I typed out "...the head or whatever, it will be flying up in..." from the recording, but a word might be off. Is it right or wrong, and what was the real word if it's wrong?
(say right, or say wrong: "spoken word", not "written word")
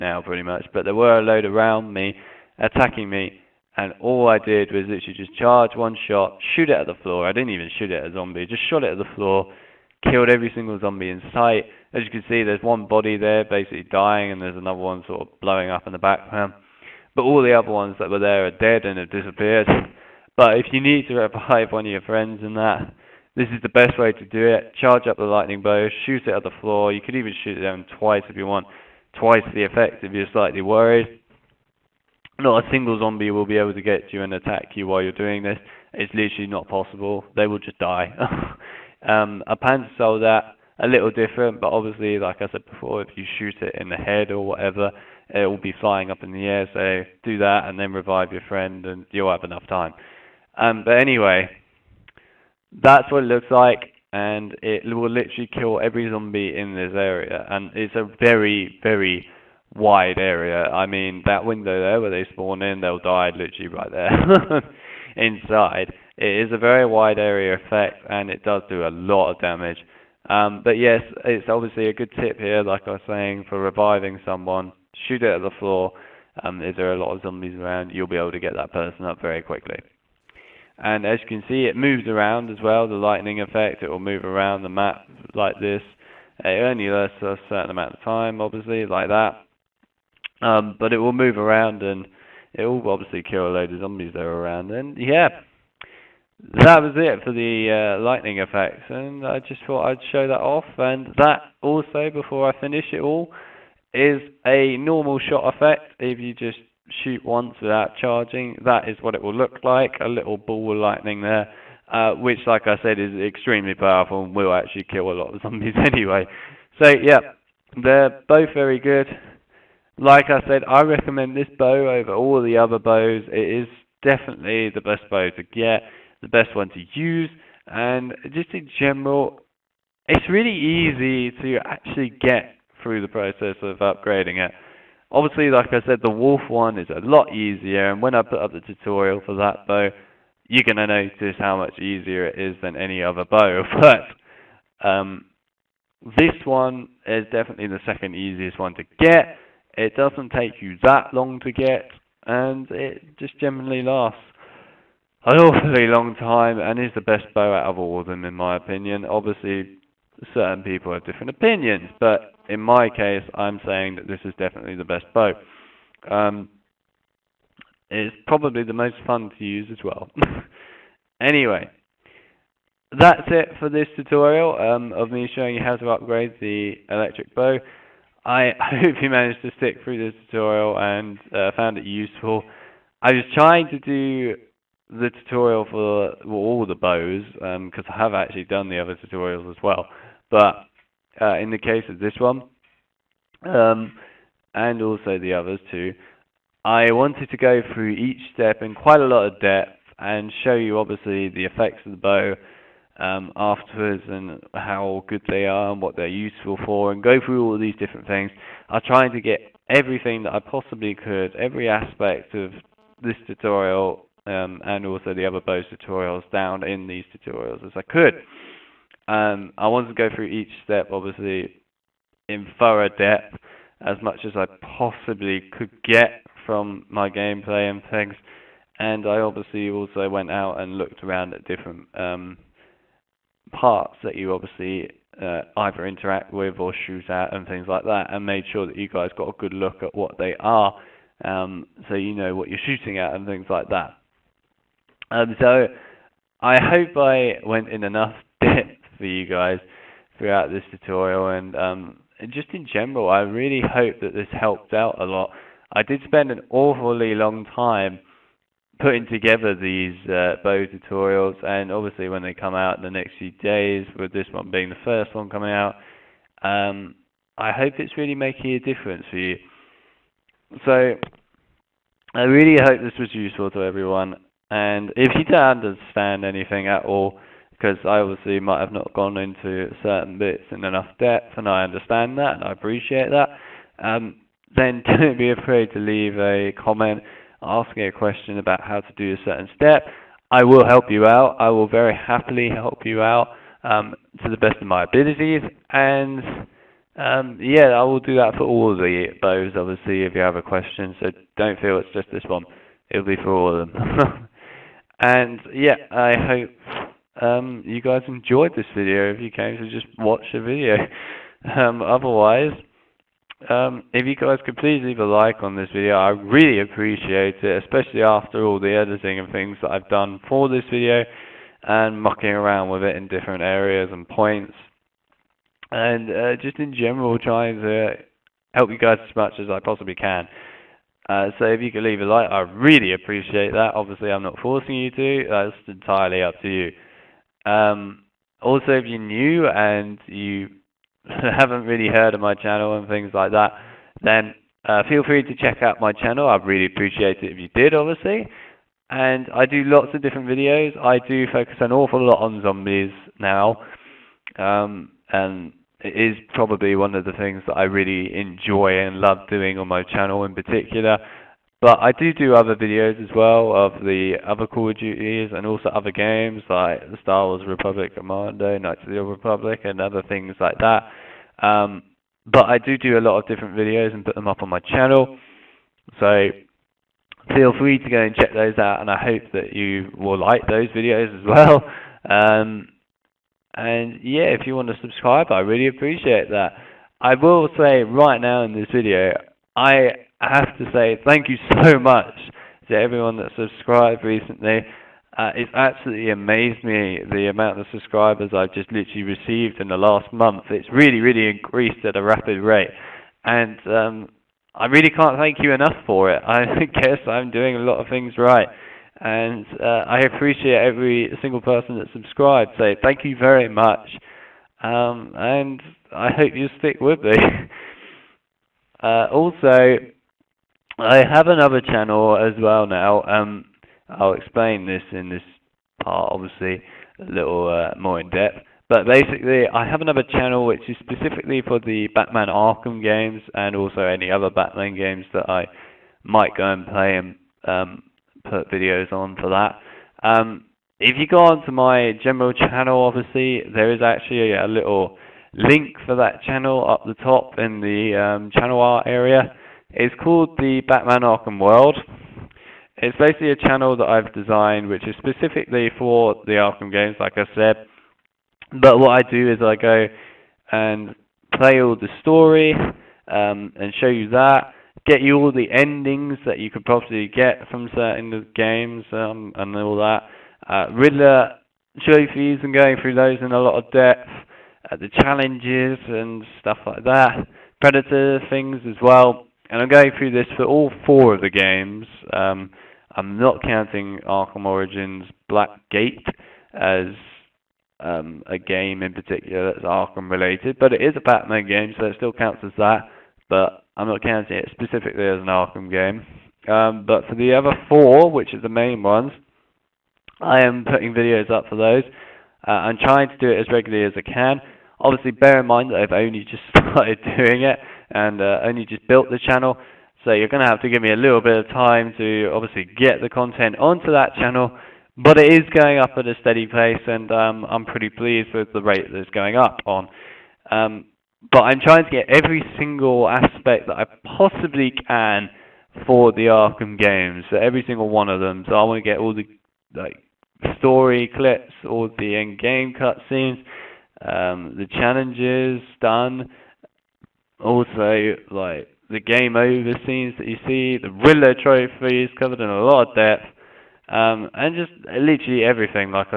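right.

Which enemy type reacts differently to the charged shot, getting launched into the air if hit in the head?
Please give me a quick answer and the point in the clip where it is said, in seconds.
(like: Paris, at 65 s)
Panzer soldat, at 39 s.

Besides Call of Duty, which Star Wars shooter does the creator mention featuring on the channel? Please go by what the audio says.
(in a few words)
Star Wars Republic Commando.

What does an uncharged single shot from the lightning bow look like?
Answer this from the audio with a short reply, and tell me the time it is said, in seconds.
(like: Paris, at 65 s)
A little ball of lightning, at 110 s.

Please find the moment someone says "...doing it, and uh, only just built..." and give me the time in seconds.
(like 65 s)
507 s.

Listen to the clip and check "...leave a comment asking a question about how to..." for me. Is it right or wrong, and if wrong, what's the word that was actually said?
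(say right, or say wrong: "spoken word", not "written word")
right.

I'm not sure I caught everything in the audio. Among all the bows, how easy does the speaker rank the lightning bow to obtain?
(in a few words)
Second easiest.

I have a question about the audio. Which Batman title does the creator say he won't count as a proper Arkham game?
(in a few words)
Arkham Origins Black Gate.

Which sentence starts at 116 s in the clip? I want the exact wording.
So, yeah, they're both very good like I said, I recommend this bow over all the other bows.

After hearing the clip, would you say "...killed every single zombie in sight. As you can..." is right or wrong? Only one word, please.
right.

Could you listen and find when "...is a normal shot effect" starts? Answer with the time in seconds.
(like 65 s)
103 s.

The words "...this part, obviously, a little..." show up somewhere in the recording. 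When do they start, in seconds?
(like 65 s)
425 s.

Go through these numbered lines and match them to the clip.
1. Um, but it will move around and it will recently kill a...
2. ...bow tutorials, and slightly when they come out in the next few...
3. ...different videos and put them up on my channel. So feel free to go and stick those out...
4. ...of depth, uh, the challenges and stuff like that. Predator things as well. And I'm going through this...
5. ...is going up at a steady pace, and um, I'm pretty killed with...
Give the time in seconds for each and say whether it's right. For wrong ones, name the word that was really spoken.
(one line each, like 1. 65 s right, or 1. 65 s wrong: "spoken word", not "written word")
1. 90 s wrong: "obviously", not "recently"
2. 260 s wrong: "obviously", not "slightly"
3. 373 s wrong: "check", not "stick"
4. 473 s right
5. 515 s wrong: "pleased", not "killed".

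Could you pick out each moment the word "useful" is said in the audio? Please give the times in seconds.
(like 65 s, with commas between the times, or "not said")
181 s, 206 s, 273 s.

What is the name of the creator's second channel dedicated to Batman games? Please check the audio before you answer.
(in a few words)
The Batman Arkham World.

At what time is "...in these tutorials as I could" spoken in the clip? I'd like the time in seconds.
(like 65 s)
216 s.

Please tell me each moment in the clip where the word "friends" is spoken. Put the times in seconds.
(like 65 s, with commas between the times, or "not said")
22 s, 48 s.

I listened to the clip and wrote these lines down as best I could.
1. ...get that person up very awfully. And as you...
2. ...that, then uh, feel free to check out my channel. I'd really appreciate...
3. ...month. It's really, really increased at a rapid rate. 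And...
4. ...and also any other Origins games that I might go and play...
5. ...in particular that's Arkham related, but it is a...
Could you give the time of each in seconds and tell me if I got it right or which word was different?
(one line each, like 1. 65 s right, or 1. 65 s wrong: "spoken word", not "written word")
1. 78 s wrong: "quickly", not "awfully"
2. 343 s right
3. 400 s right
4. 433 s wrong: "Batman", not "Origins"
5. 488 s right.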